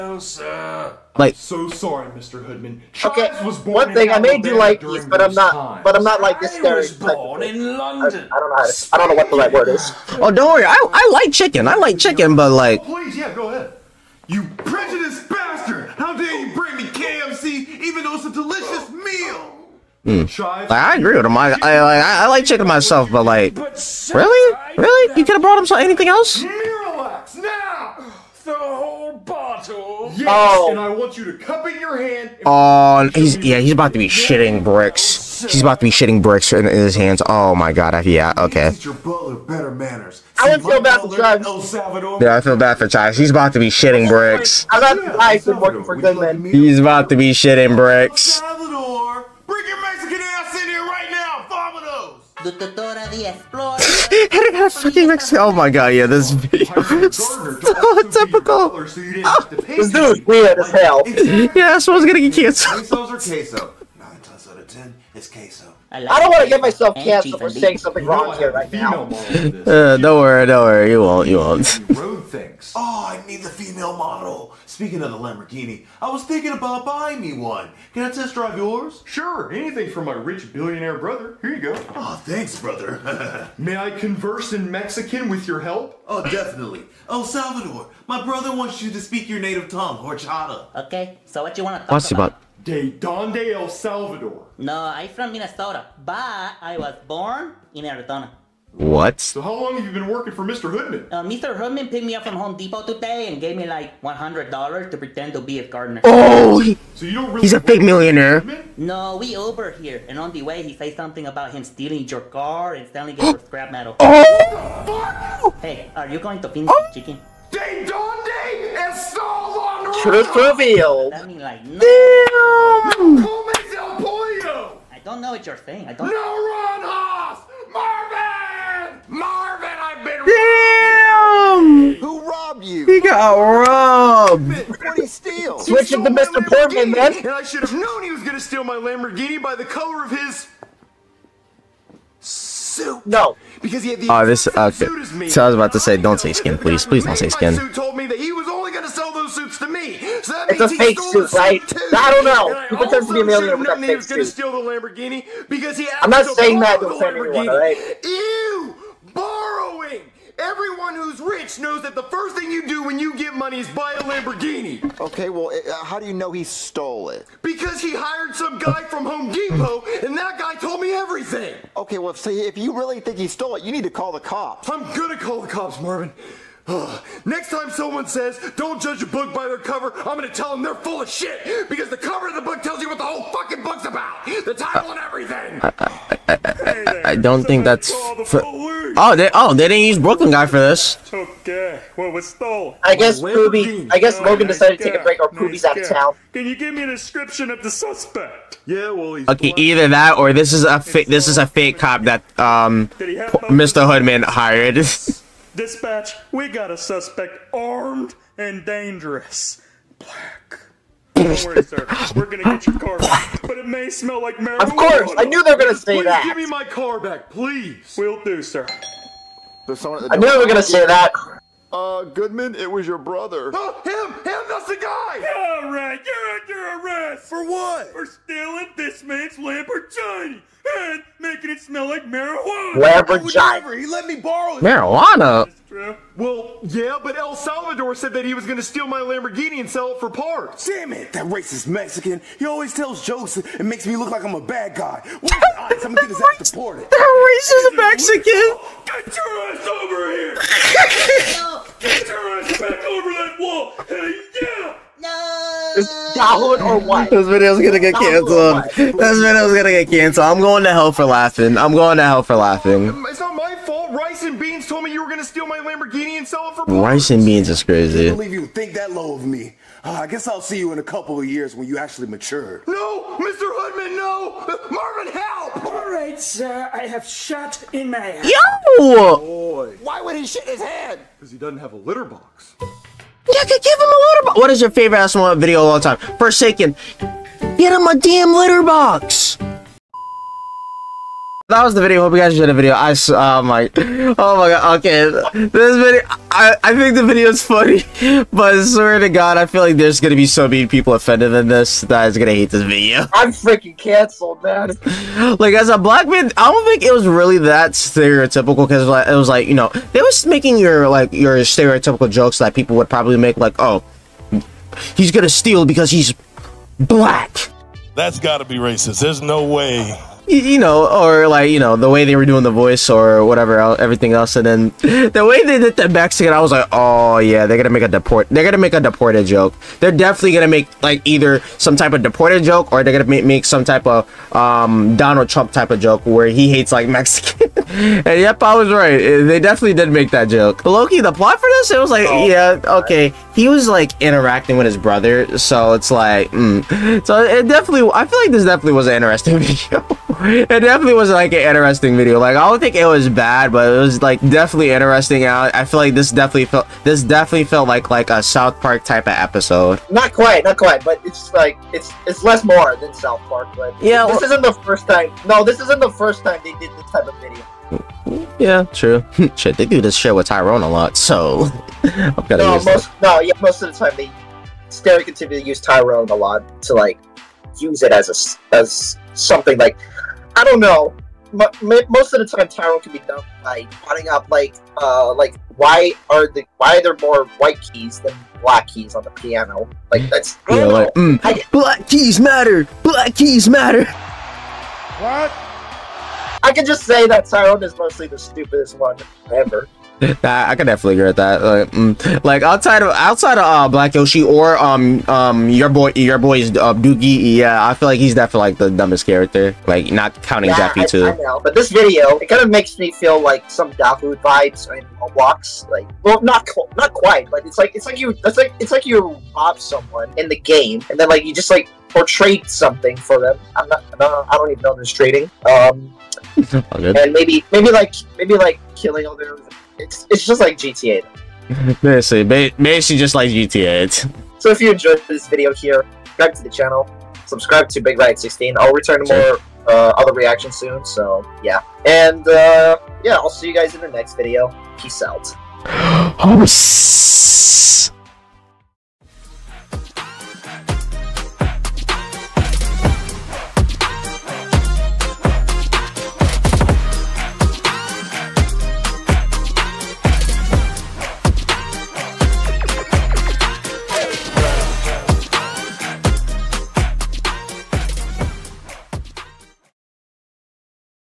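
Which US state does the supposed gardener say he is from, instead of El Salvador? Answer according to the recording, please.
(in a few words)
Minnesota.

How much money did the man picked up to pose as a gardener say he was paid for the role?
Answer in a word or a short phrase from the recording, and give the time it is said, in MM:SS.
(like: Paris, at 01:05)
$100, at 01:44.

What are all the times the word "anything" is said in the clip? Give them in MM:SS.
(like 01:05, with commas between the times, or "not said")
00:25, 01:19.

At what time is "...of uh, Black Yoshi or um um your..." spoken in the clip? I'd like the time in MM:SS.
06:43.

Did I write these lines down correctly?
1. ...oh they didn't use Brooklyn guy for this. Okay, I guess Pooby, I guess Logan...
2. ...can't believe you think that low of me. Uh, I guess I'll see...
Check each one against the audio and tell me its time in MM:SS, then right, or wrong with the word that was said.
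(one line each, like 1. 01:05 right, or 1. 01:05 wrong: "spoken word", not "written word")
1. 03:09 right
2. 04:28 right.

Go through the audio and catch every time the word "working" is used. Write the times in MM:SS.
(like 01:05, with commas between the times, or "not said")
00:45, 01:40.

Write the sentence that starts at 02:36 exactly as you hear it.
I'm not saying that to offend anyone.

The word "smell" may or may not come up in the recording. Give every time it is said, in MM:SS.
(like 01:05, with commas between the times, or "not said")
03:33, 03:51.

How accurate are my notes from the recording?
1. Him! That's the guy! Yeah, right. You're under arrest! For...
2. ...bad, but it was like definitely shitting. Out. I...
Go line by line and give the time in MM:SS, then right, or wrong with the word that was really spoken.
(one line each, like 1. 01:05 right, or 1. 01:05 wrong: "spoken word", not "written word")
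1. 03:44 right
2. 05:53 wrong: "interesting", not "shitting".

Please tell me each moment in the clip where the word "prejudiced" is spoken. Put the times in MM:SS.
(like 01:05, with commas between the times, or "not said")
00:14.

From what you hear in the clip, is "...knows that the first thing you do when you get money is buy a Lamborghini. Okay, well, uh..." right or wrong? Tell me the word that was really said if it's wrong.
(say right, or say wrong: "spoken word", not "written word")
right.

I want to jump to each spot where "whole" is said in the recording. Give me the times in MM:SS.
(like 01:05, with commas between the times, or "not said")
00:28, 03:03.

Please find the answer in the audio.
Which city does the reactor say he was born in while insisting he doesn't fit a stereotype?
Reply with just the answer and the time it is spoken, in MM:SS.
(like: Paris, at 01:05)
London, at 00:07.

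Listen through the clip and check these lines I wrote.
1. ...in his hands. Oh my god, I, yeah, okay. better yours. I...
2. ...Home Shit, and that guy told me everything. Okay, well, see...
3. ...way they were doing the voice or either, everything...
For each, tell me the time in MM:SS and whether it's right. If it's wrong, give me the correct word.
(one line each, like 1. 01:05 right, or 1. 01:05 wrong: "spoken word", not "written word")
1. 00:36 wrong: "manners", not "yours"
2. 02:49 wrong: "Depot", not "Shit"
3. 05:21 wrong: "whatever", not "either".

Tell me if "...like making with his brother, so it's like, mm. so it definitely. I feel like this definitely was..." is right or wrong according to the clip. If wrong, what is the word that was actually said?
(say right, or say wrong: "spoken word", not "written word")
wrong: "interacting", not "making".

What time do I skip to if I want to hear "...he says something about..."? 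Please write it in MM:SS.
01:50.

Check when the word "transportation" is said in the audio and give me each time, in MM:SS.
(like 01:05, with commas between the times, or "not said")
not said.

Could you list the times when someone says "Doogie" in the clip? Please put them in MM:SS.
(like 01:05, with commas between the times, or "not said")
06:46.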